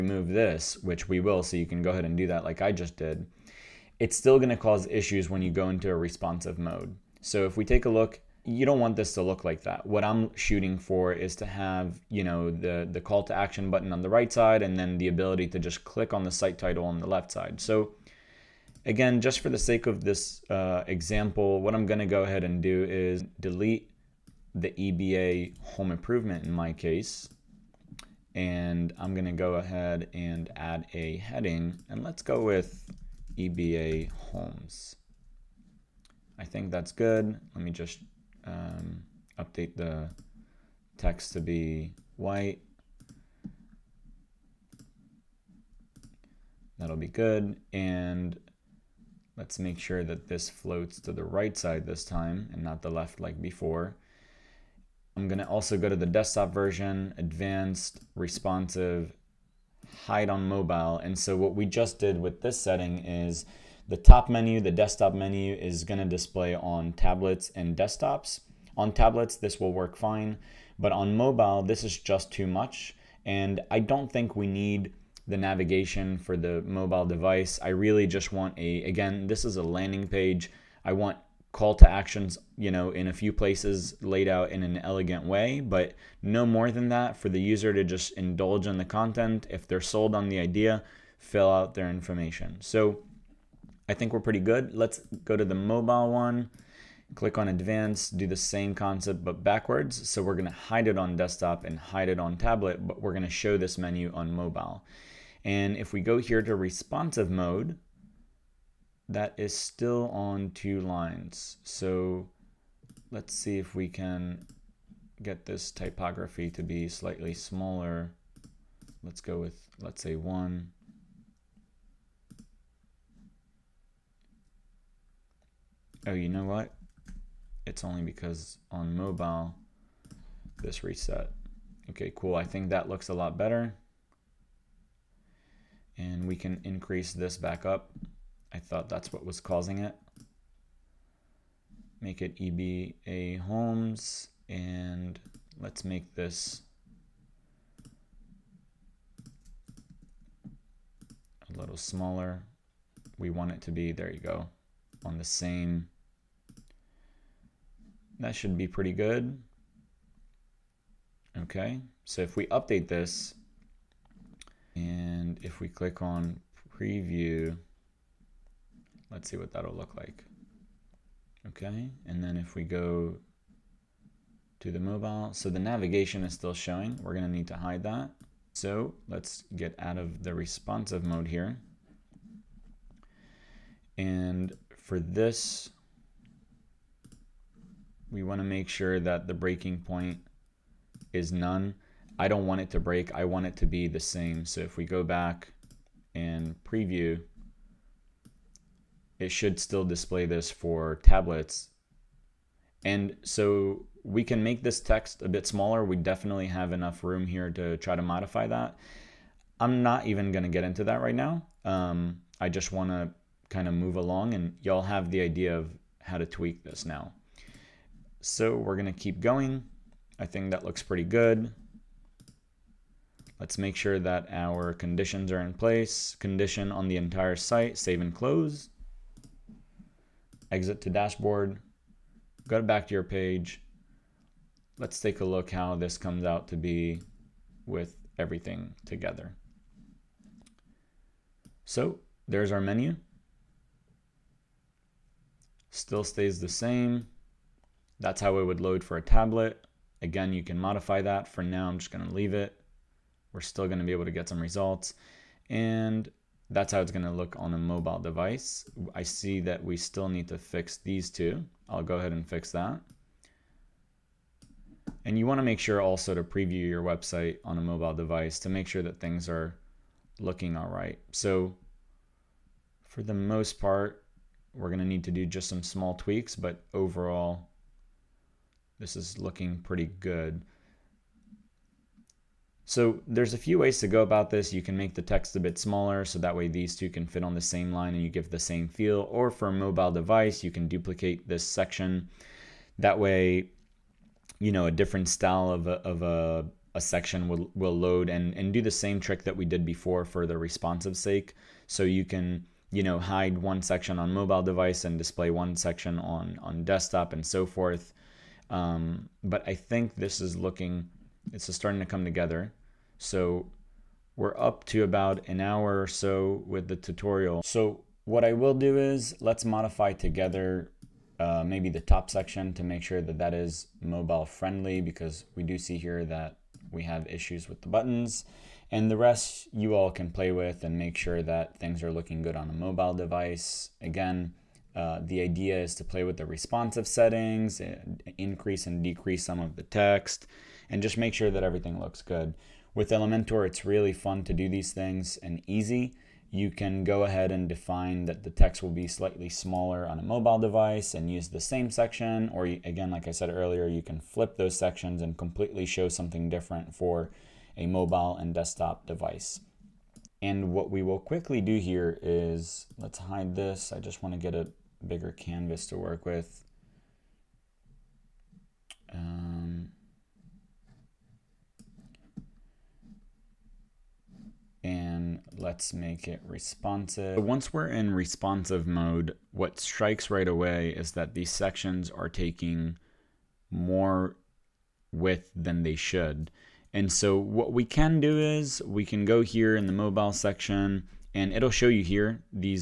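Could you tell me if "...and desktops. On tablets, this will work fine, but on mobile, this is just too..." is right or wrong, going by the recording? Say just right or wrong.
right.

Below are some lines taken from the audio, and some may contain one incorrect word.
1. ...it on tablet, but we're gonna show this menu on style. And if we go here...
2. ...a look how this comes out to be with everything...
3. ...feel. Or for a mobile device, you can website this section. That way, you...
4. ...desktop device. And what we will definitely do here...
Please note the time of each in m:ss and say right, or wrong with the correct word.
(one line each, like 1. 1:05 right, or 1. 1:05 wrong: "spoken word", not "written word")
1. 1:42 wrong: "mobile", not "style"
2. 3:55 right
3. 4:48 wrong: "duplicate", not "website"
4. 5:58 wrong: "quickly", not "definitely".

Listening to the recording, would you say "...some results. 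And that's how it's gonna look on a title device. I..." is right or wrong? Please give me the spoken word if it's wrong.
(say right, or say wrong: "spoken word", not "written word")
wrong: "mobile", not "title".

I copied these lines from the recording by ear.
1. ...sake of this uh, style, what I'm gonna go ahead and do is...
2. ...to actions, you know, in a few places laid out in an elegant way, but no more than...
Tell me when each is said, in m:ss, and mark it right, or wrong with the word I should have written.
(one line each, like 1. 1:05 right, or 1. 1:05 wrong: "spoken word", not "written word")
1. 0:19 wrong: "example", not "style"
2. 1:21 right.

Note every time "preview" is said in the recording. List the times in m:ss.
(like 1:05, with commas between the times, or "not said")
2:46, 3:16, 4:26.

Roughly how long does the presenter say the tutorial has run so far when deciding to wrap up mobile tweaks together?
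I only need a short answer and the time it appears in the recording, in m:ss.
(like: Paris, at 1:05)
about an hour, at 5:14.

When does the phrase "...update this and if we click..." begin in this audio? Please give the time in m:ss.
2:42.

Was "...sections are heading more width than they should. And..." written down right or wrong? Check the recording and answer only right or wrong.
wrong.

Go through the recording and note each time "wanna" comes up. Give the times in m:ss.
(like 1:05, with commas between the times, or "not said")
3:08, 4:25.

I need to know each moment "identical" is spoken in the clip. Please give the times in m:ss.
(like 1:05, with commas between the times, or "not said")
not said.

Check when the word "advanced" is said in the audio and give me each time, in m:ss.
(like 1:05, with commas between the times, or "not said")
0:57, 1:37.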